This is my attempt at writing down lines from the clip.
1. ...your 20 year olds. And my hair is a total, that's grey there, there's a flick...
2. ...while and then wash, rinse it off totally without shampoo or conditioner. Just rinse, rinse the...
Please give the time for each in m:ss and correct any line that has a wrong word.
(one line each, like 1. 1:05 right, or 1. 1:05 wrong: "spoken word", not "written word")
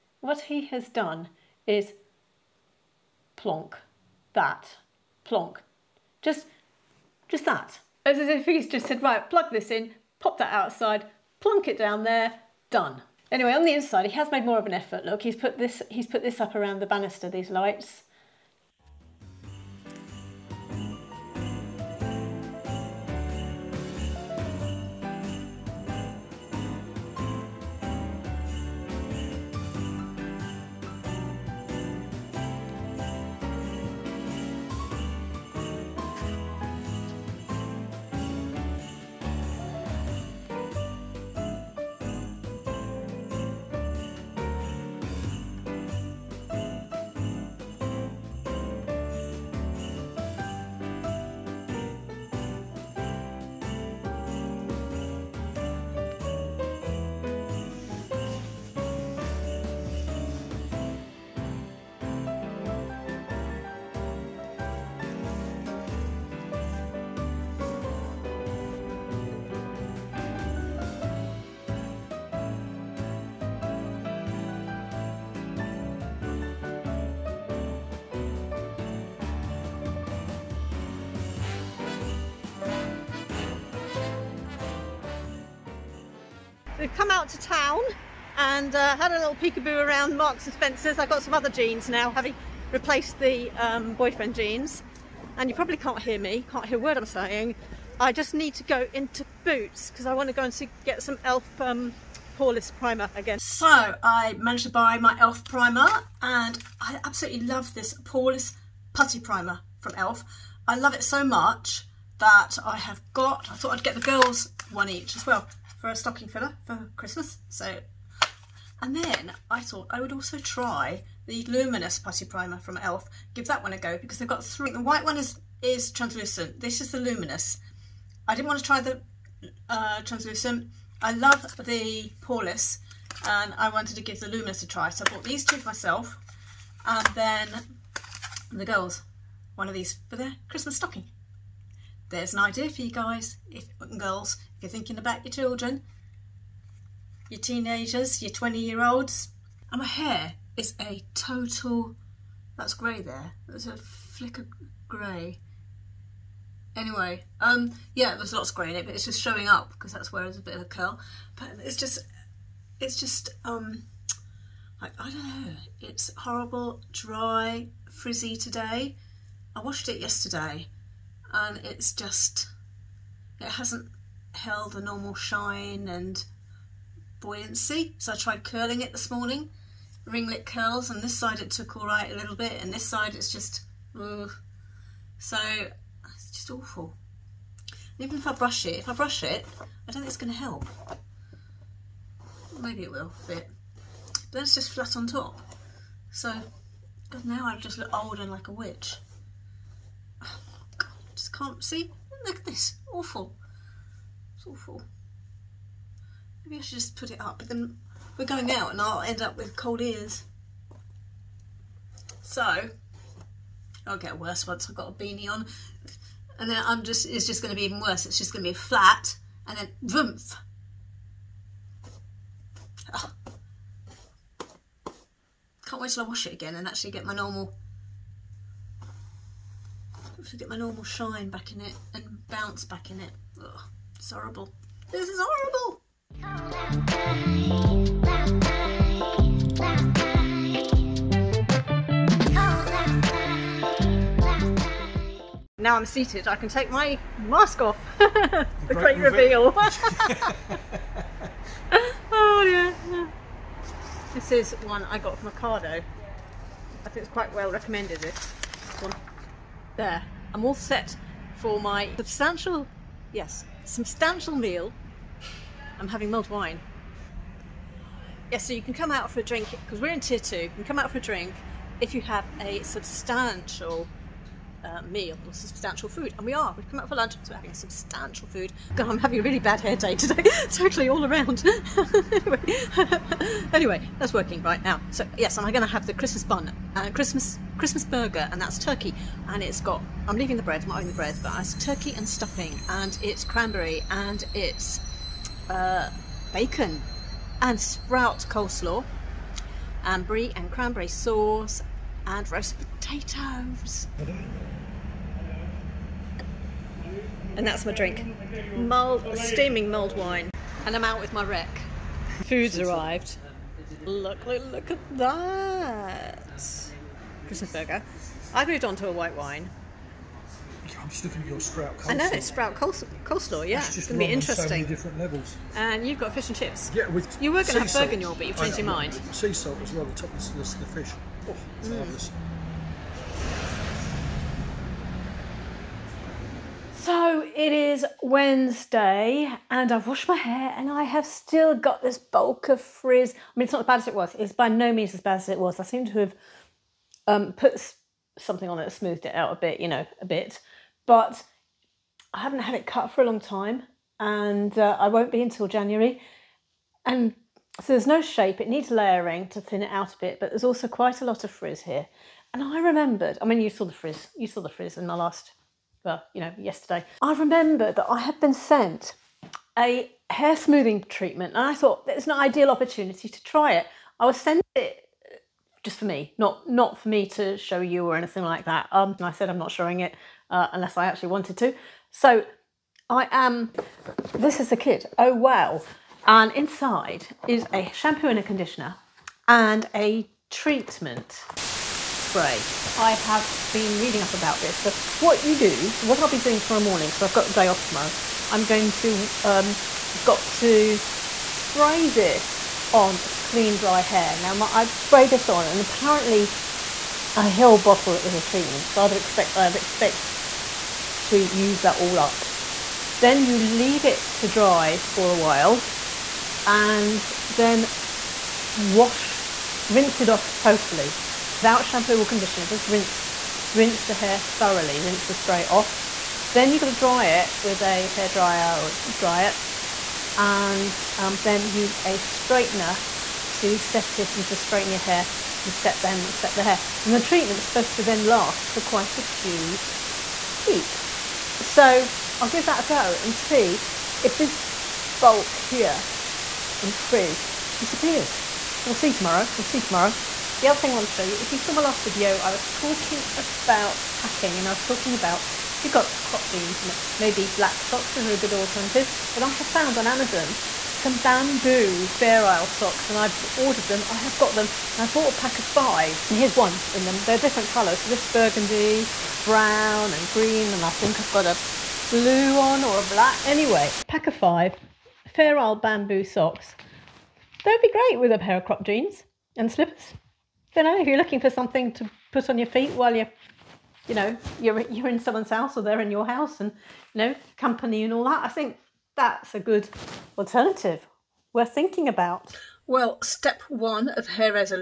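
1. 2:28 right
2. 6:55 right.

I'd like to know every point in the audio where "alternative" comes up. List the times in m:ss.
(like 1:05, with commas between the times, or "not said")
7:38, 8:10.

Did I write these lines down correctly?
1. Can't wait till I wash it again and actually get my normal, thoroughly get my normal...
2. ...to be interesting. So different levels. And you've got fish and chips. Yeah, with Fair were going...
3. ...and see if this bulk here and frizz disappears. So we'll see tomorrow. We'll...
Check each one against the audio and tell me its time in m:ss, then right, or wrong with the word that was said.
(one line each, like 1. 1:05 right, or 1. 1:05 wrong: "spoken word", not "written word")
1. 3:45 wrong: "hopefully", not "thoroughly"
2. 5:24 wrong: "You", not "Fair"
3. 7:23 right.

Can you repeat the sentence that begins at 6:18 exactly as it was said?
Um, and I said I'm not showing it uh, unless I actually wanted to.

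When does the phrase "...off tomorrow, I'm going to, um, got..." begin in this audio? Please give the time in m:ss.
6:37.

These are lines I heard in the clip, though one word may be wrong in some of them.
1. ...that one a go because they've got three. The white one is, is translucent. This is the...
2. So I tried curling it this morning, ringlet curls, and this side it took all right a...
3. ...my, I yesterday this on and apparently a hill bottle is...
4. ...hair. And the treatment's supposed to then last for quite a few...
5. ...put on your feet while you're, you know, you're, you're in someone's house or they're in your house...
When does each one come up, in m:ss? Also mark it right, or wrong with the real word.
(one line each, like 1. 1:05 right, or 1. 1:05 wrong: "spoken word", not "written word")
1. 2:03 right
2. 2:57 right
3. 6:44 wrong: "spray", not "yesterday"
4. 7:16 right
5. 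8:02 right.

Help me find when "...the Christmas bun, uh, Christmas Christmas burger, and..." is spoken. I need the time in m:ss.
4:45.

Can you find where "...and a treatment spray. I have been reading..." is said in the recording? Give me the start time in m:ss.
6:29.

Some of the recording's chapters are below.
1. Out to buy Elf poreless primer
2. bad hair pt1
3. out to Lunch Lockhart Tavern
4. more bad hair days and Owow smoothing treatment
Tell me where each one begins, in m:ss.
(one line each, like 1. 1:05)
1. 1:26
2. 2:29
3. 3:55
4. 5:37.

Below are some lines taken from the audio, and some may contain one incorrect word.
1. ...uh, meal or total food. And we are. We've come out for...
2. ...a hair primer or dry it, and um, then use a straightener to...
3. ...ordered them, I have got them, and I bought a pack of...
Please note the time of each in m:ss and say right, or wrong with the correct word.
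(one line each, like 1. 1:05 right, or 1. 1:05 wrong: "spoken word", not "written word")
1. 4:34 wrong: "substantial", not "total"
2. 7:07 wrong: "dryer", not "primer"
3. 7:43 right.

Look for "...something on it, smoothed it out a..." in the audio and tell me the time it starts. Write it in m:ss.
5:48.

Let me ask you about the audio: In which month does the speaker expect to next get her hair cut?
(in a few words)
January.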